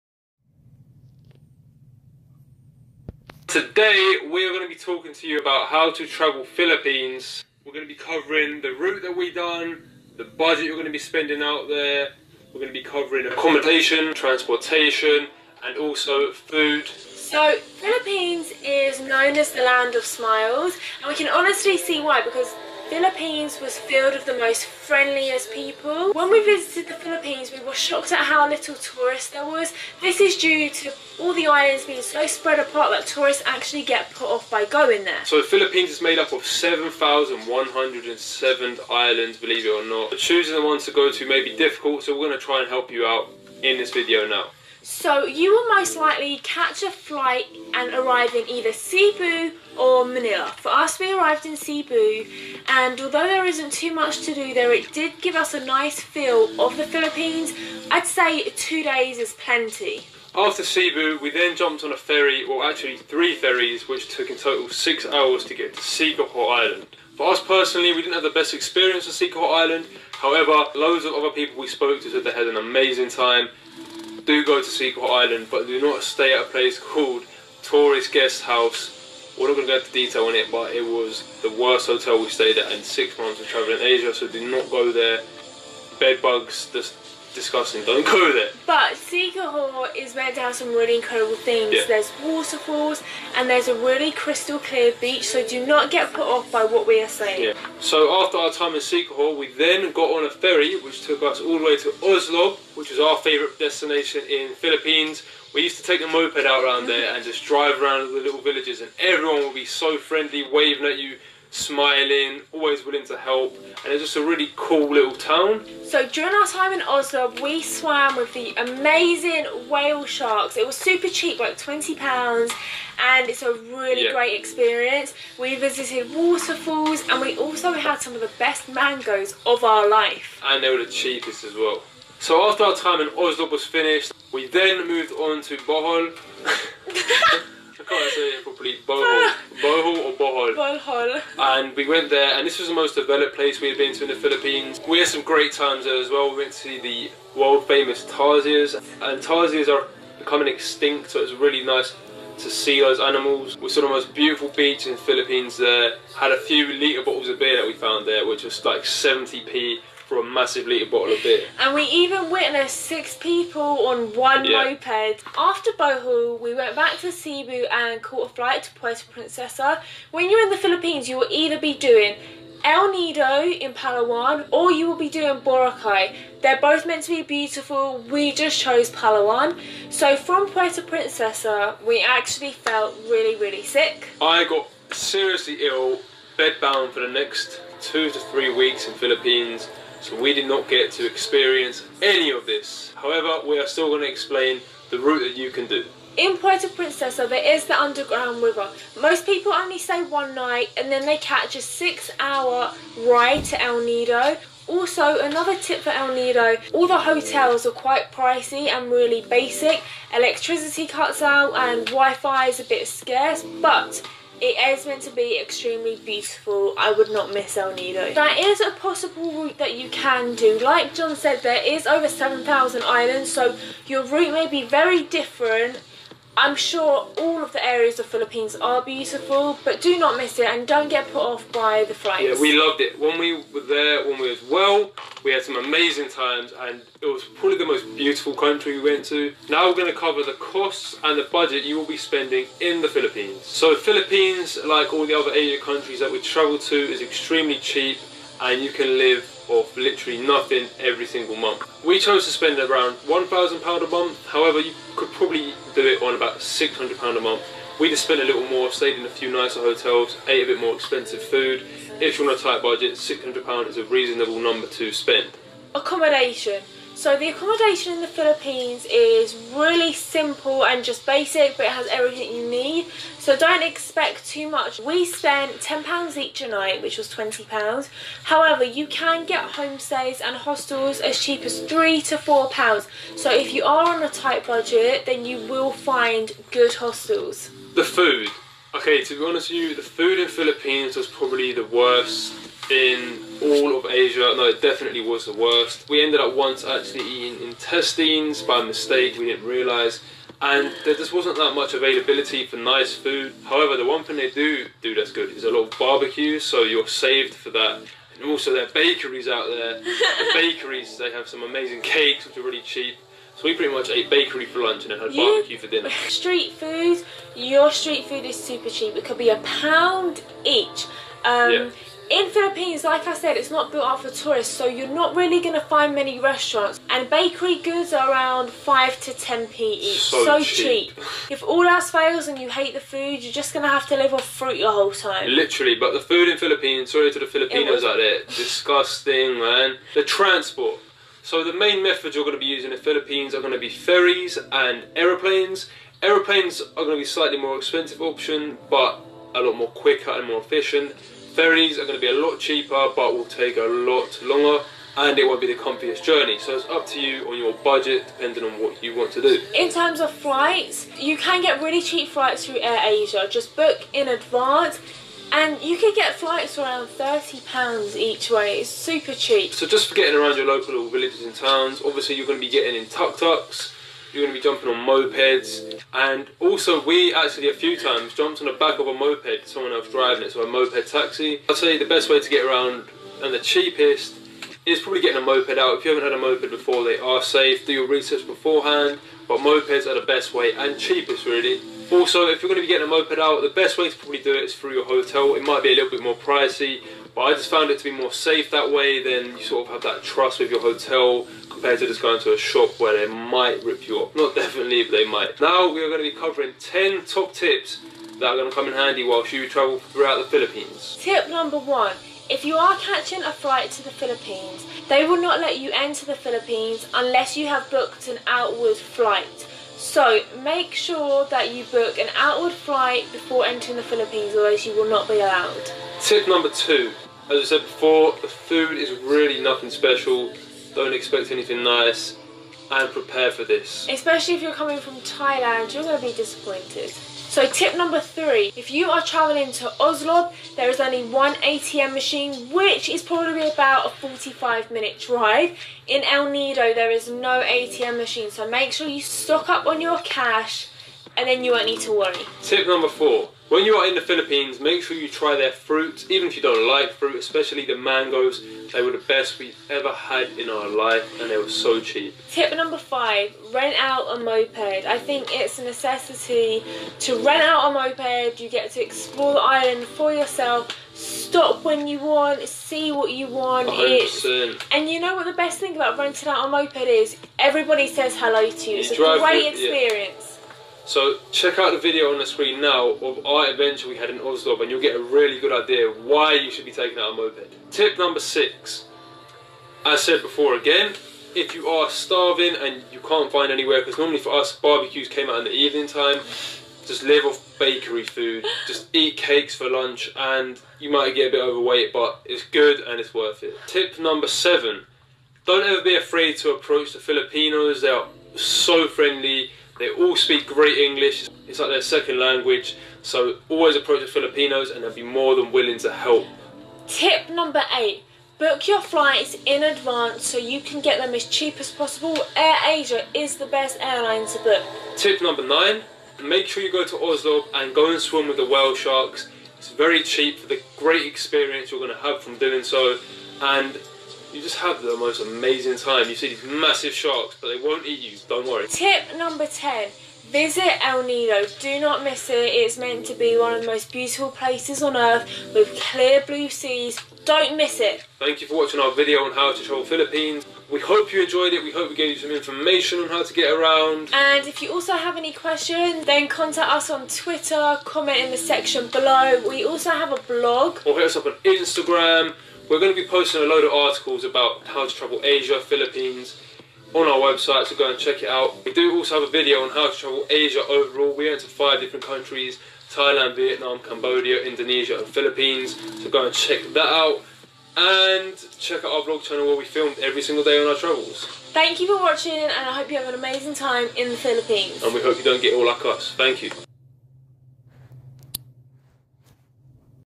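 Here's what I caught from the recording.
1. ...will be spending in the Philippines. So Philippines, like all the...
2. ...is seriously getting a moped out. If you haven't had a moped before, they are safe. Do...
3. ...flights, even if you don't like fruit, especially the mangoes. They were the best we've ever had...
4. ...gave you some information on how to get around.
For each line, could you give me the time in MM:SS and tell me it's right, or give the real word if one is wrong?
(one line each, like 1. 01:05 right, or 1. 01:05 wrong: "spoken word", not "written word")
1. 04:01 right
2. 06:24 wrong: "probably", not "seriously"
3. 07:35 wrong: "fruits", not "flights"
4. 09:11 right.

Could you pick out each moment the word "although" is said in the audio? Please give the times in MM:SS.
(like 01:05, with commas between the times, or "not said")
00:52.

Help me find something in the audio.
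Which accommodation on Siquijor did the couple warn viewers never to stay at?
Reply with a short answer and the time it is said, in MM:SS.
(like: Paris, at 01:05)
Tourist Guest House, at 01:17.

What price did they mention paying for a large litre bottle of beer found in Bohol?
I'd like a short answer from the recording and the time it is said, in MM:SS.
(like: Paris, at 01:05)
70p, at 02:38.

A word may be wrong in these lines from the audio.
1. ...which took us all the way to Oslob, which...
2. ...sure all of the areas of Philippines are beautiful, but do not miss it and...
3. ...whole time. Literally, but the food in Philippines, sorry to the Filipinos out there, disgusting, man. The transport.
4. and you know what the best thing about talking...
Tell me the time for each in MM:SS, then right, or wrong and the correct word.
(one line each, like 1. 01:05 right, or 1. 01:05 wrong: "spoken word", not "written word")
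1. 01:40 right
2. 03:46 right
3. 05:34 right
4. 07:54 wrong: "renting", not "talking".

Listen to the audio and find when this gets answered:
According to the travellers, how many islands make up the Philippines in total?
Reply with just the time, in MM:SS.
00:36.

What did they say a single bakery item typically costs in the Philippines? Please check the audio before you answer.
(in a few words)
5 to 10p.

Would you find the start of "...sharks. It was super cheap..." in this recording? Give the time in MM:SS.
02:00.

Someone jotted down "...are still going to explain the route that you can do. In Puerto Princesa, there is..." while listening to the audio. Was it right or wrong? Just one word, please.
right.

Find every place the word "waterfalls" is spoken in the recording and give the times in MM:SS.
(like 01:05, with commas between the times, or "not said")
01:32, 02:06.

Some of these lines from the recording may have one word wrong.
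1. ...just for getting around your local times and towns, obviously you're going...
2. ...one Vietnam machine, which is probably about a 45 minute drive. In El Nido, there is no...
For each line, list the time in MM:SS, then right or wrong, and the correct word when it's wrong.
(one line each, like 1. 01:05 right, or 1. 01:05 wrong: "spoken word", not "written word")
1. 06:09 wrong: "villages", not "times"
2. 07:21 wrong: "ATM", not "Vietnam".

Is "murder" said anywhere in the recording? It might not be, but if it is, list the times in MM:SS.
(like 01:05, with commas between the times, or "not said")
not said.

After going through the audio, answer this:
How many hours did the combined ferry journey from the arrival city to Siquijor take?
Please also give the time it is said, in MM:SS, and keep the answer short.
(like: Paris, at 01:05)
6 hours, at 01:04.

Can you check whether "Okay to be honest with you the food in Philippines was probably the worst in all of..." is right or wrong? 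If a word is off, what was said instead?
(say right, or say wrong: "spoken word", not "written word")
right.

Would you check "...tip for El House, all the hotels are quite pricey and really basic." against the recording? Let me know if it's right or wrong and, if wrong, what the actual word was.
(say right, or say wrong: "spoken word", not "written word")
wrong: "Nido", not "House".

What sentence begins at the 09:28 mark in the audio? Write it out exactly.
We do also have a video on how to travel Asia overall.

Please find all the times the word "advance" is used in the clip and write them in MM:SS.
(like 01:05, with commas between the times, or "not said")
06:04, 08:39.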